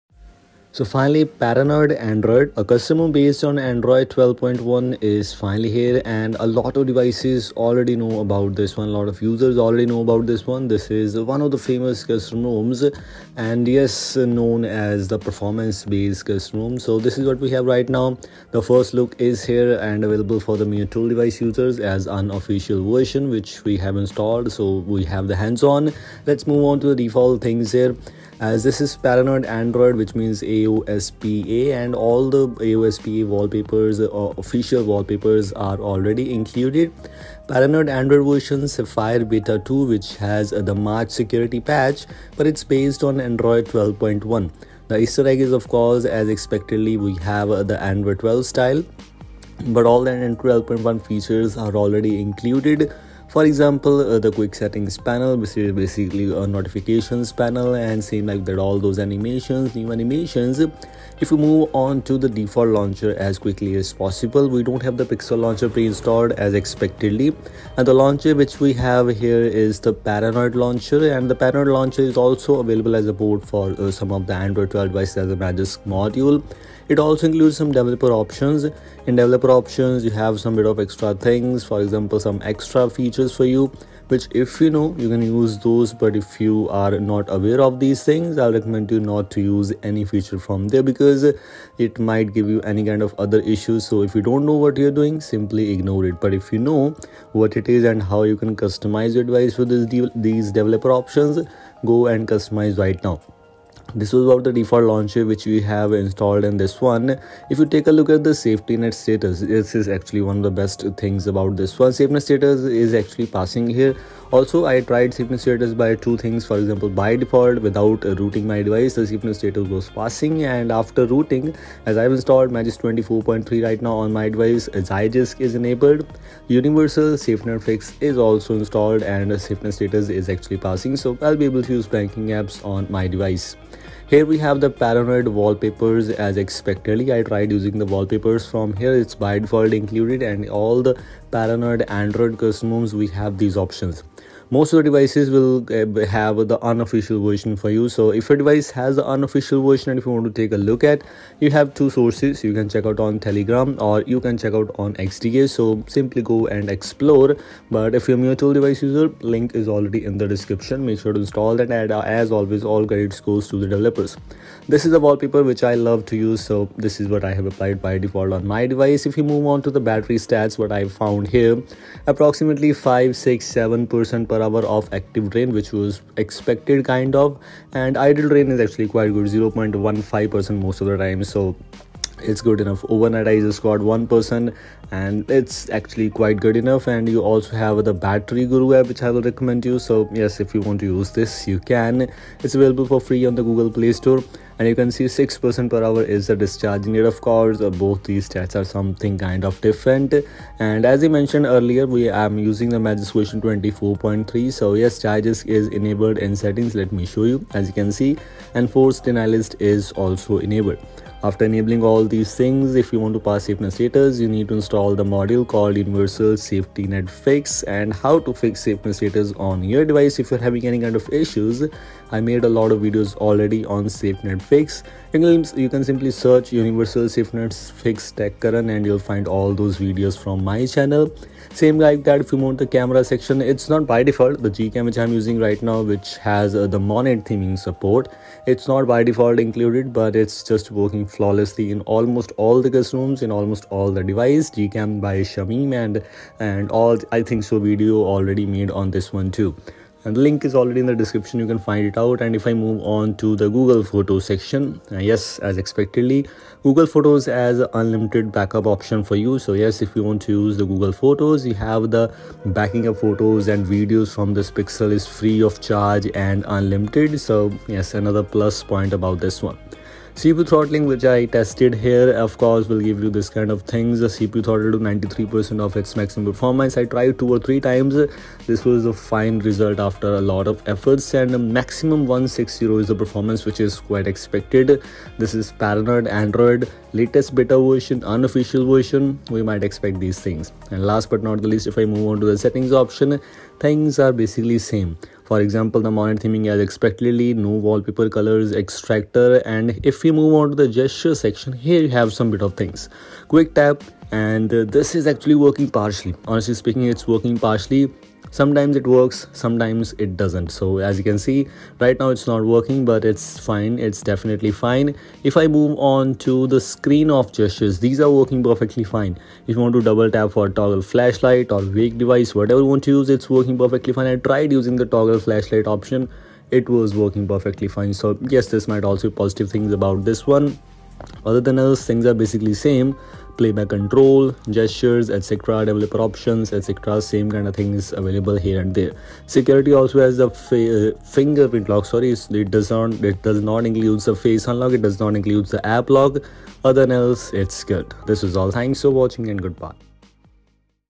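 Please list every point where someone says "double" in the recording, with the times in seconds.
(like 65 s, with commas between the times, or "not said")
319 s.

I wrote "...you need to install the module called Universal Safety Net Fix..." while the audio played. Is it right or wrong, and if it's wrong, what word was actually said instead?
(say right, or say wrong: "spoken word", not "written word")
right.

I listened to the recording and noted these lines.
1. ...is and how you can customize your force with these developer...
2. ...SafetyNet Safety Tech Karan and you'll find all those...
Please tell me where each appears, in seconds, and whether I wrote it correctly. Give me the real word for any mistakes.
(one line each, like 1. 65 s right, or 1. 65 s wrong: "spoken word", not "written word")
1. 97 s wrong: "device", not "force"
2. 227 s wrong: "Fix", not "Safety".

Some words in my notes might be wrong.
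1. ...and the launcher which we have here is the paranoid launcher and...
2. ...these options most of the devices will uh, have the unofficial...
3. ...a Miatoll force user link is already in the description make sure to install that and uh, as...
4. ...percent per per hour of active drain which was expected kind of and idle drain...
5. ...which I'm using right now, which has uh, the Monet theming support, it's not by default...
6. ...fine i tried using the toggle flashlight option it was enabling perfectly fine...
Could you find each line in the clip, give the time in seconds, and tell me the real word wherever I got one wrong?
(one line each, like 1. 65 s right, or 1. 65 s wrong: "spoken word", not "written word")
1. 67 s right
2. 143 s right
3. 158 s wrong: "device", not "force"
4. 173 s right
5. 234 s right
6. 323 s wrong: "working", not "enabling".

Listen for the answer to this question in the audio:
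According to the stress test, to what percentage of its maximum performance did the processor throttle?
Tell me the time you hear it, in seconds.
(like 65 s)
274 s.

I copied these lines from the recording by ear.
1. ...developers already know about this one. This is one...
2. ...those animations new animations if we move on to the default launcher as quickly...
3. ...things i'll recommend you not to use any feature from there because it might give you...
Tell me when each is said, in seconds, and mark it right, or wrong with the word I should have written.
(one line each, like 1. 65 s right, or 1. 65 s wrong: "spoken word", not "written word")
1. 9 s wrong: "users", not "developers"
2. 58 s right
3. 88 s right.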